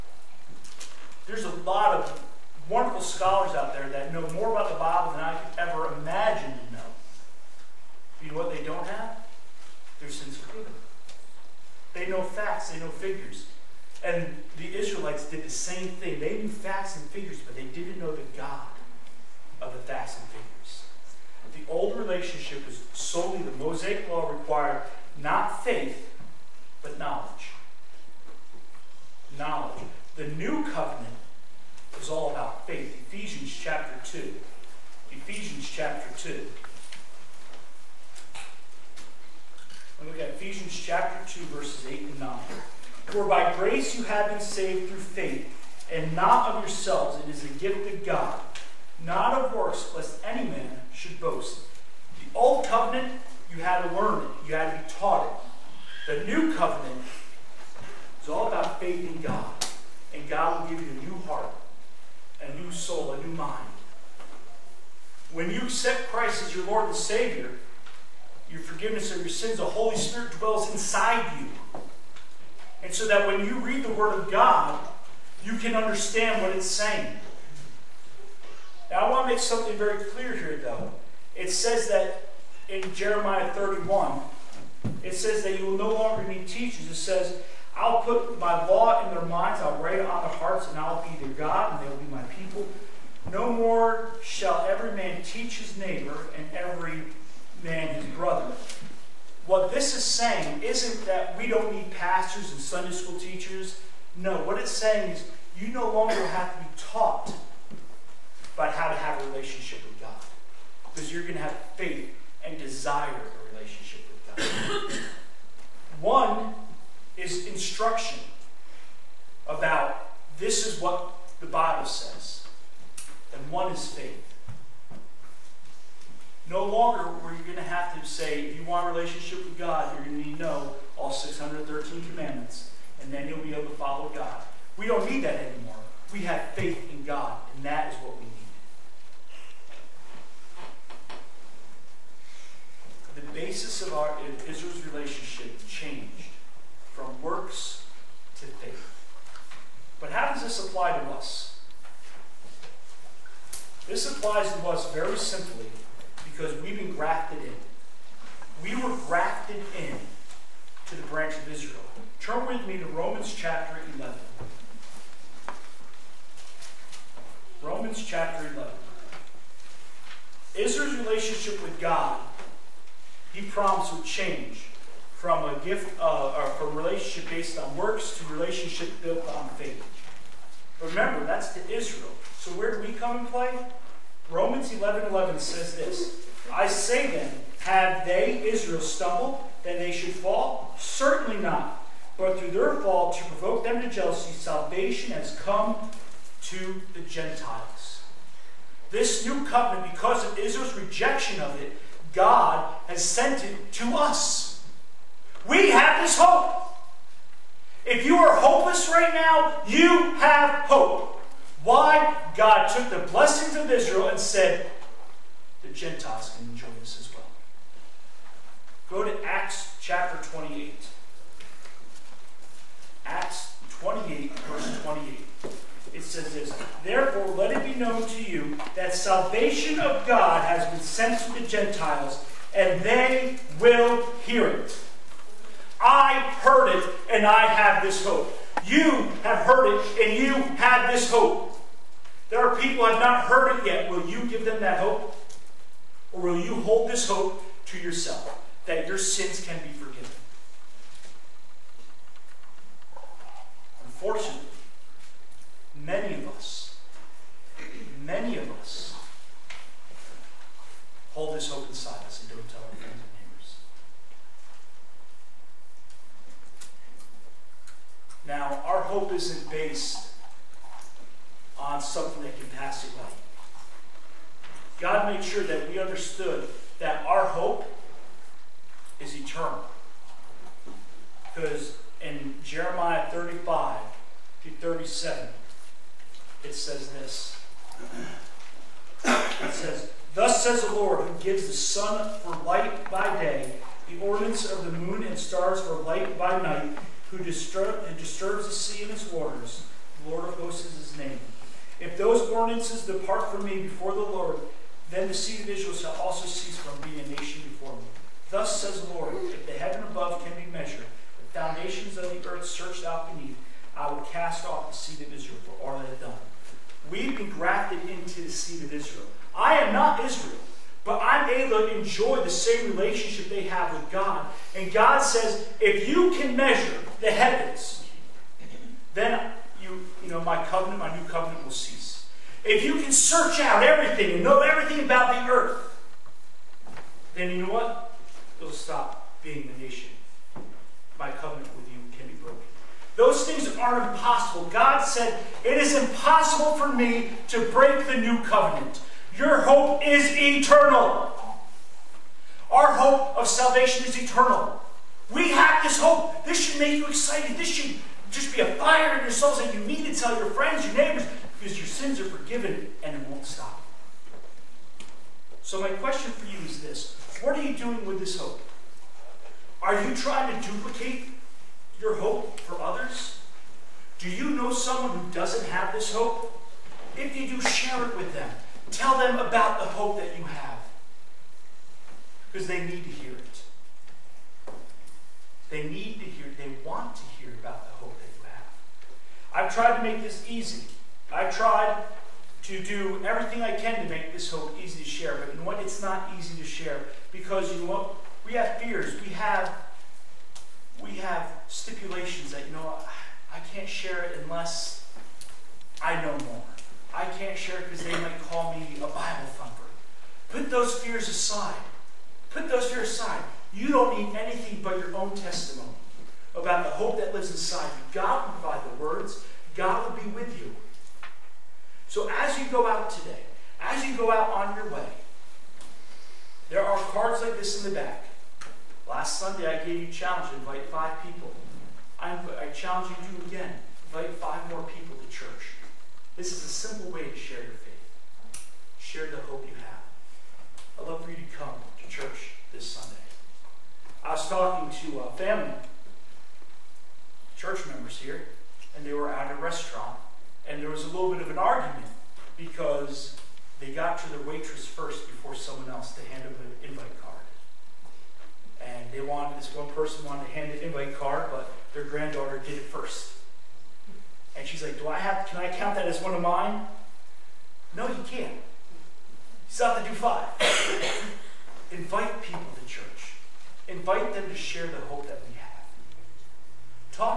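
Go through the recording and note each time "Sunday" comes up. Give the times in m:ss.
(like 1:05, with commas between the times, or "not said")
1:42, 7:09, 7:22.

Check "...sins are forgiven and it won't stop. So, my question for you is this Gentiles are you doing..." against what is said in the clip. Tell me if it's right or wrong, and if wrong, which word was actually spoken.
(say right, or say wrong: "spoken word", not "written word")
wrong: "What", not "Gentiles".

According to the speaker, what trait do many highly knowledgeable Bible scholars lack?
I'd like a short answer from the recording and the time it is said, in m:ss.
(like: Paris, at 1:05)
Sense of humor, at 0:10.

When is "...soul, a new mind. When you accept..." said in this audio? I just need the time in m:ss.
1:02.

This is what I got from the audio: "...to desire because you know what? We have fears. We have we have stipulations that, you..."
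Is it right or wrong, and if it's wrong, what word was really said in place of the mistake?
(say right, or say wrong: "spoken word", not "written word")
wrong: "share", not "desire".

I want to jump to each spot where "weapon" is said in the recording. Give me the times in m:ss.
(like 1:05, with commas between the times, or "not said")
not said.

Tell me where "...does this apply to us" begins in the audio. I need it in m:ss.
2:30.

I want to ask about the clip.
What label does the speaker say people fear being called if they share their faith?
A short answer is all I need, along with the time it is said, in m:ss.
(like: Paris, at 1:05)
Bible thumper, at 6:48.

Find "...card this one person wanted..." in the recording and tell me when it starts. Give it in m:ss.
7:37.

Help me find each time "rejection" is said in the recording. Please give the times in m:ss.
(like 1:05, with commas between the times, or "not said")
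3:20.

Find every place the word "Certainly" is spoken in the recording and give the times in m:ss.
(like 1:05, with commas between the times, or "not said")
3:10.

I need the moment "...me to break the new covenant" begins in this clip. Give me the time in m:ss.
5:46.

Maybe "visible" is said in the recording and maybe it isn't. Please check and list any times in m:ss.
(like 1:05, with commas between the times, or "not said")
not said.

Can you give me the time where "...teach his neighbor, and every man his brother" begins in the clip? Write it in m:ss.
1:35.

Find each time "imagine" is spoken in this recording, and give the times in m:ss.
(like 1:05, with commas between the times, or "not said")
0:05.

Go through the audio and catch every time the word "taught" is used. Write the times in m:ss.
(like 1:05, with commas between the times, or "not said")
0:54, 1:46.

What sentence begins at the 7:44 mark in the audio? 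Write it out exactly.
And she's like, Do I have can I count that as one of mine?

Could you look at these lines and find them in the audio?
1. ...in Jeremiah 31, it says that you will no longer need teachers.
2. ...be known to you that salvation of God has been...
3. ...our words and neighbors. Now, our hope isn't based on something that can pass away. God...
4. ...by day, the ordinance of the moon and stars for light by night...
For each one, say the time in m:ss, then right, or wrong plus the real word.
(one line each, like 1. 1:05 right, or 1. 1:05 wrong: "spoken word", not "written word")
1. 1:22 right
2. 3:47 right
3. 4:22 wrong: "friends", not "words"
4. 4:52 right.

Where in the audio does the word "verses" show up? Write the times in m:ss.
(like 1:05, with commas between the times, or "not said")
0:41, 3:44.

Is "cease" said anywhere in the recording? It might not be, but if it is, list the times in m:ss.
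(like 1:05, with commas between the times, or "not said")
5:06, 5:31.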